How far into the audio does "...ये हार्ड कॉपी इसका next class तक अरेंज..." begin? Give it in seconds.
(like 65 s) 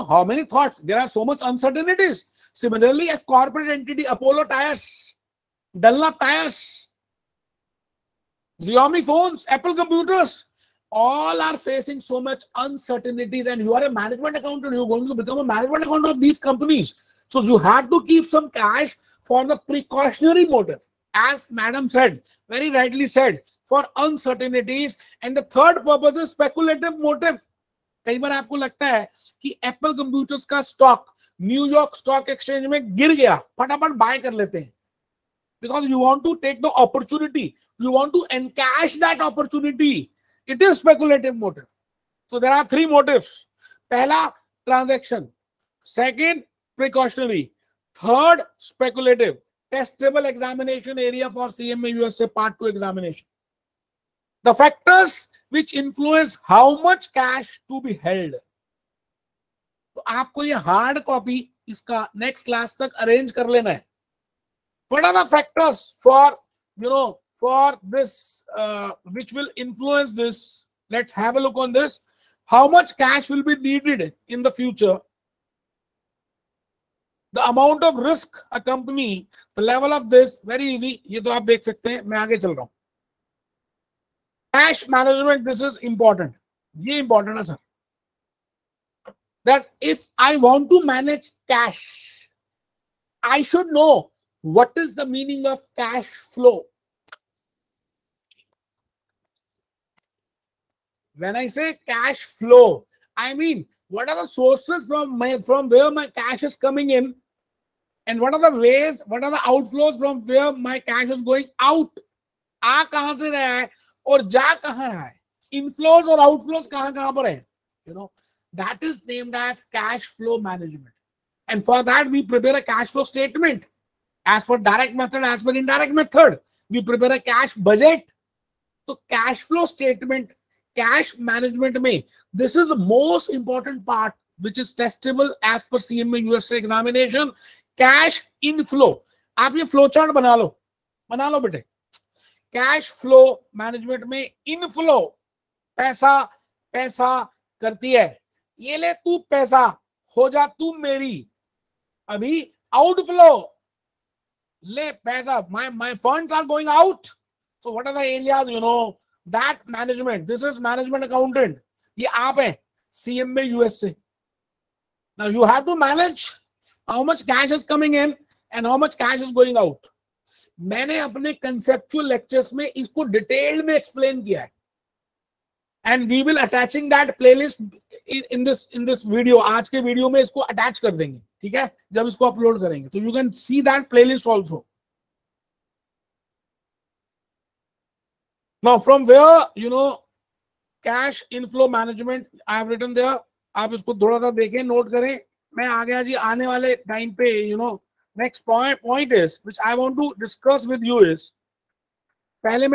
60 s.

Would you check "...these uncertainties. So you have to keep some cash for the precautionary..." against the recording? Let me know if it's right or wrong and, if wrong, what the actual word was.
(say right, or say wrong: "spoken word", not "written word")
wrong: "companies", not "uncertainties".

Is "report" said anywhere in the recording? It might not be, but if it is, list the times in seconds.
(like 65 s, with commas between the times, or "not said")
not said.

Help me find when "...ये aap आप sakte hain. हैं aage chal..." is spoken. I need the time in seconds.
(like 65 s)
81 s.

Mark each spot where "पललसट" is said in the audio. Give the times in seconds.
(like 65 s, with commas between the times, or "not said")
177 s, 183 s.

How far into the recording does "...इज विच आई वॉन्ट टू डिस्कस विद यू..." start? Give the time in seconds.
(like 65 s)
199 s.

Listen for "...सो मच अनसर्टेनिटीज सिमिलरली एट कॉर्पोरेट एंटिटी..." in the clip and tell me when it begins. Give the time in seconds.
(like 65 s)
1 s.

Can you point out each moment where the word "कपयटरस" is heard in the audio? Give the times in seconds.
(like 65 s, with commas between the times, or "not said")
29 s.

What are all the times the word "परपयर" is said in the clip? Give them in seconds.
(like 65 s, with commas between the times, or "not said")
122 s, 126 s.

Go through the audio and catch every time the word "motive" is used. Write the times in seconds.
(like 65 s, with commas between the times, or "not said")
20 s, 26 s.